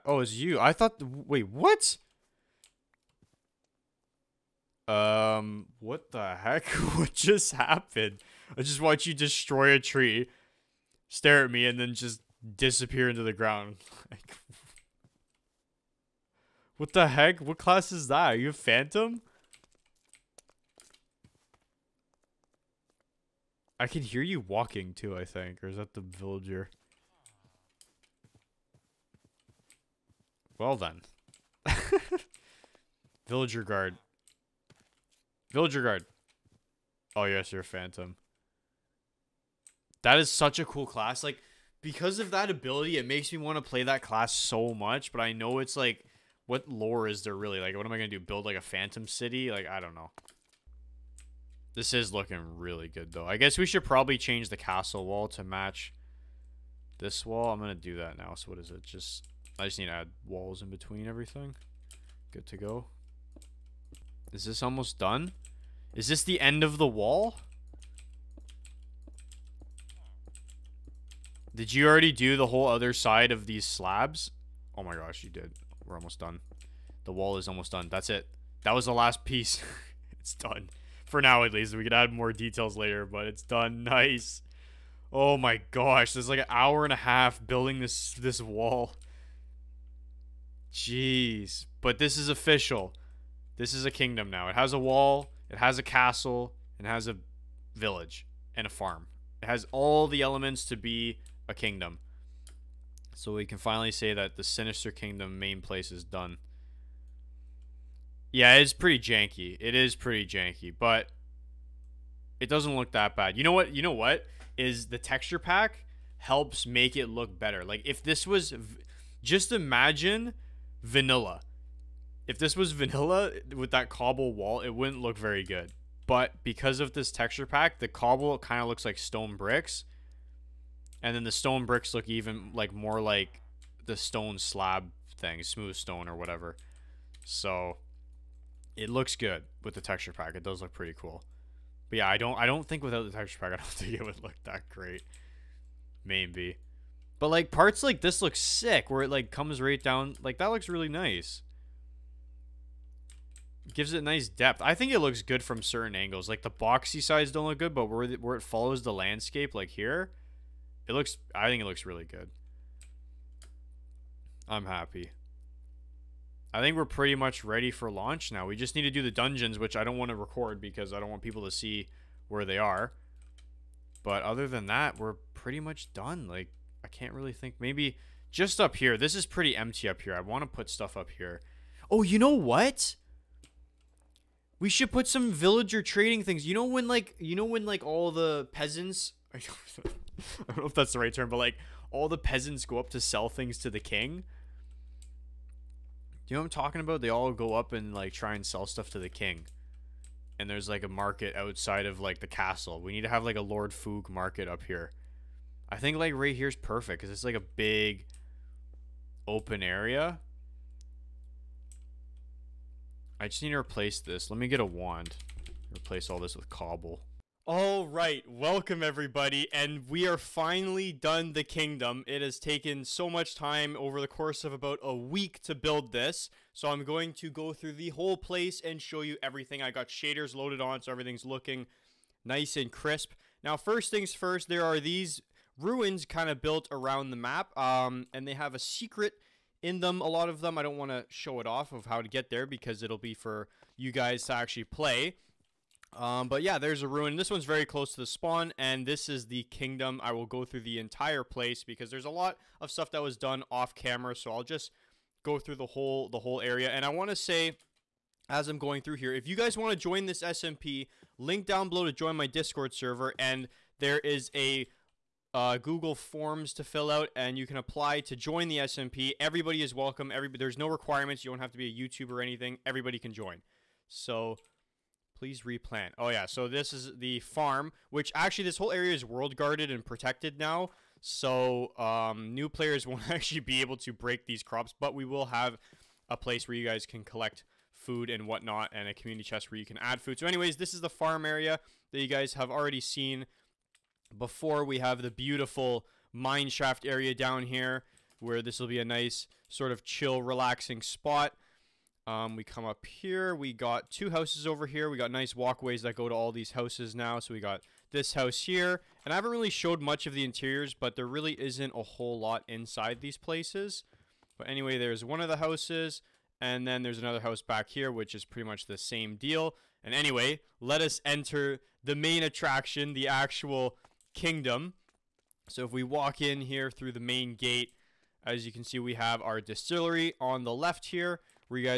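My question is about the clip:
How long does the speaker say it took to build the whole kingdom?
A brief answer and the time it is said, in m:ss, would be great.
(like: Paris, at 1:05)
About a week, at 3:44.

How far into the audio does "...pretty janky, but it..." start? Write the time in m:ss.
1:49.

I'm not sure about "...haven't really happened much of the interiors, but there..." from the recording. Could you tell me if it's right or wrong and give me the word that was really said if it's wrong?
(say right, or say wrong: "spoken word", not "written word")
wrong: "showed", not "happened".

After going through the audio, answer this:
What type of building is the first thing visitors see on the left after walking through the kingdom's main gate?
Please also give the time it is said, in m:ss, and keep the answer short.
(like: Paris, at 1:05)
Distillery, at 5:29.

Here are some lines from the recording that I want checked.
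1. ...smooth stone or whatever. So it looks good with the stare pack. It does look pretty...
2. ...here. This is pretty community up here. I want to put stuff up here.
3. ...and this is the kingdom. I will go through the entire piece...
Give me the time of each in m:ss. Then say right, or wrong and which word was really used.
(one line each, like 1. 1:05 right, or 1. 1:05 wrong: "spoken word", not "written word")
1. 2:15 wrong: "texture", not "stare"
2. 2:58 wrong: "empty", not "community"
3. 4:08 wrong: "place", not "piece".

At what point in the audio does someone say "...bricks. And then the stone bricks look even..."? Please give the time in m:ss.
2:09.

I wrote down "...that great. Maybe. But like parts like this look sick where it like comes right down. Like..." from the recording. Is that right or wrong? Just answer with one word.
right.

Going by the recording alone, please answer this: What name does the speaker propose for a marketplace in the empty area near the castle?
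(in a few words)
Lord Fug market.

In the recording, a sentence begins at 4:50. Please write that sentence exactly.
So anyways, this is the farm area that you guys have already seen before.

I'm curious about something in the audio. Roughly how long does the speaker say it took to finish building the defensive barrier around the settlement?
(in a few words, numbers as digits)
an hour and a half.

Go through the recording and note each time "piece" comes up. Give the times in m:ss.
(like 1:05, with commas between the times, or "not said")
1:19.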